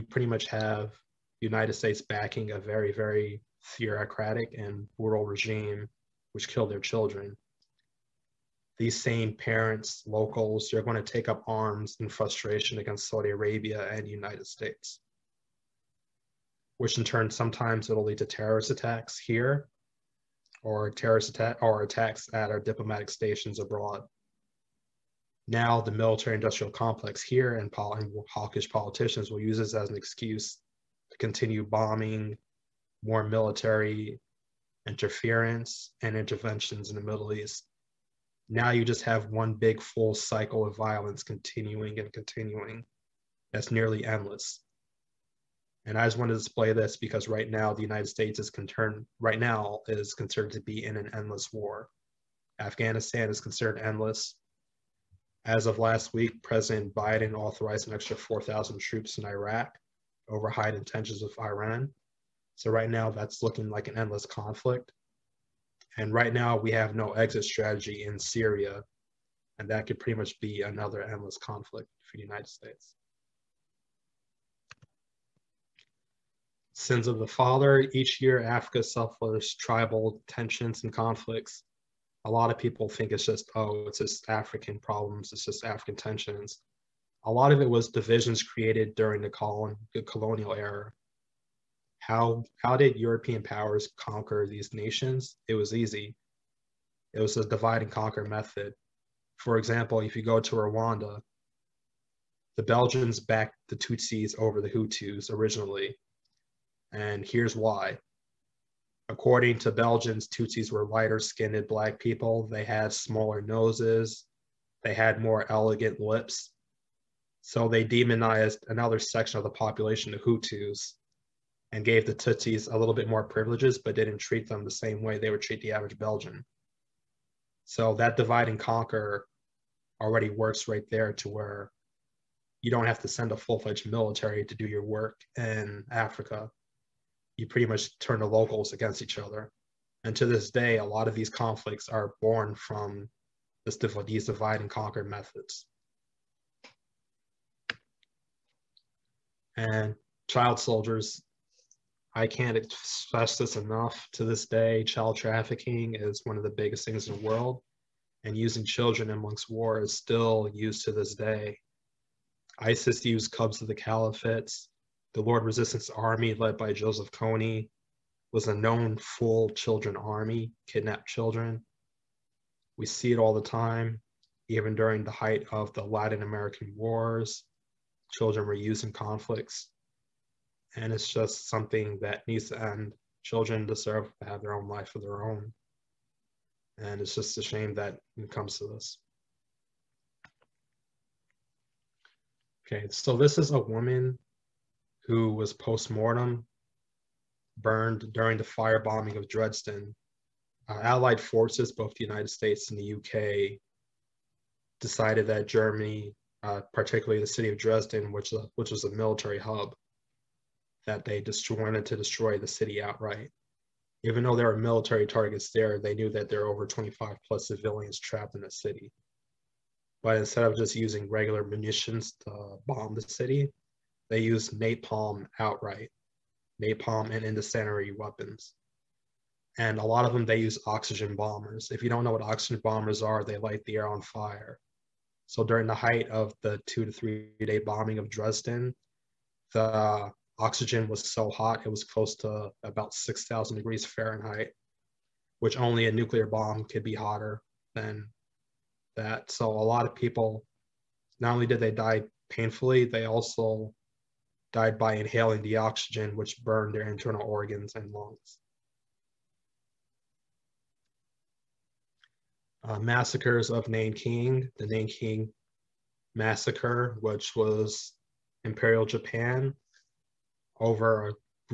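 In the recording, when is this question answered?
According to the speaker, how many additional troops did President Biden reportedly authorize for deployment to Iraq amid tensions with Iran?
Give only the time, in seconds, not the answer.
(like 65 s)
58 s.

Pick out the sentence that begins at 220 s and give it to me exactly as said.
But instead of just using regular munitions to bomb the city, they use napalm outright, napalm and incendiary weapons.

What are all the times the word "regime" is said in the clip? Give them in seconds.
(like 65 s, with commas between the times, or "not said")
5 s.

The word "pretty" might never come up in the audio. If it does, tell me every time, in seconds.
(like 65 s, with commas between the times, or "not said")
0 s, 69 s, 137 s.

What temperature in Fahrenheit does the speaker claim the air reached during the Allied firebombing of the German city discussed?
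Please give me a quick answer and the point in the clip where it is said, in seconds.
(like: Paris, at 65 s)
6,000 degrees Fahrenheit, at 242 s.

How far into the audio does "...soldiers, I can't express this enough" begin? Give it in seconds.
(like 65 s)
150 s.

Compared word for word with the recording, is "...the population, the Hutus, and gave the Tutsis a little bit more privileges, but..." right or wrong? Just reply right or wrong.
right.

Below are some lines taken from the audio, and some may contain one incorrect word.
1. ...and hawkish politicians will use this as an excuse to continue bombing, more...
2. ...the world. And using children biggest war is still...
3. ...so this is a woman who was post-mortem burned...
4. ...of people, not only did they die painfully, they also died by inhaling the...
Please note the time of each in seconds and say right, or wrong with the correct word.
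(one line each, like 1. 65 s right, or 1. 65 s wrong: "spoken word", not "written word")
1. 27 s right
2. 157 s wrong: "amongst", not "biggest"
3. 192 s right
4. 249 s right.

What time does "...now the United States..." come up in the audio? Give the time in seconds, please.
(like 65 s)
47 s.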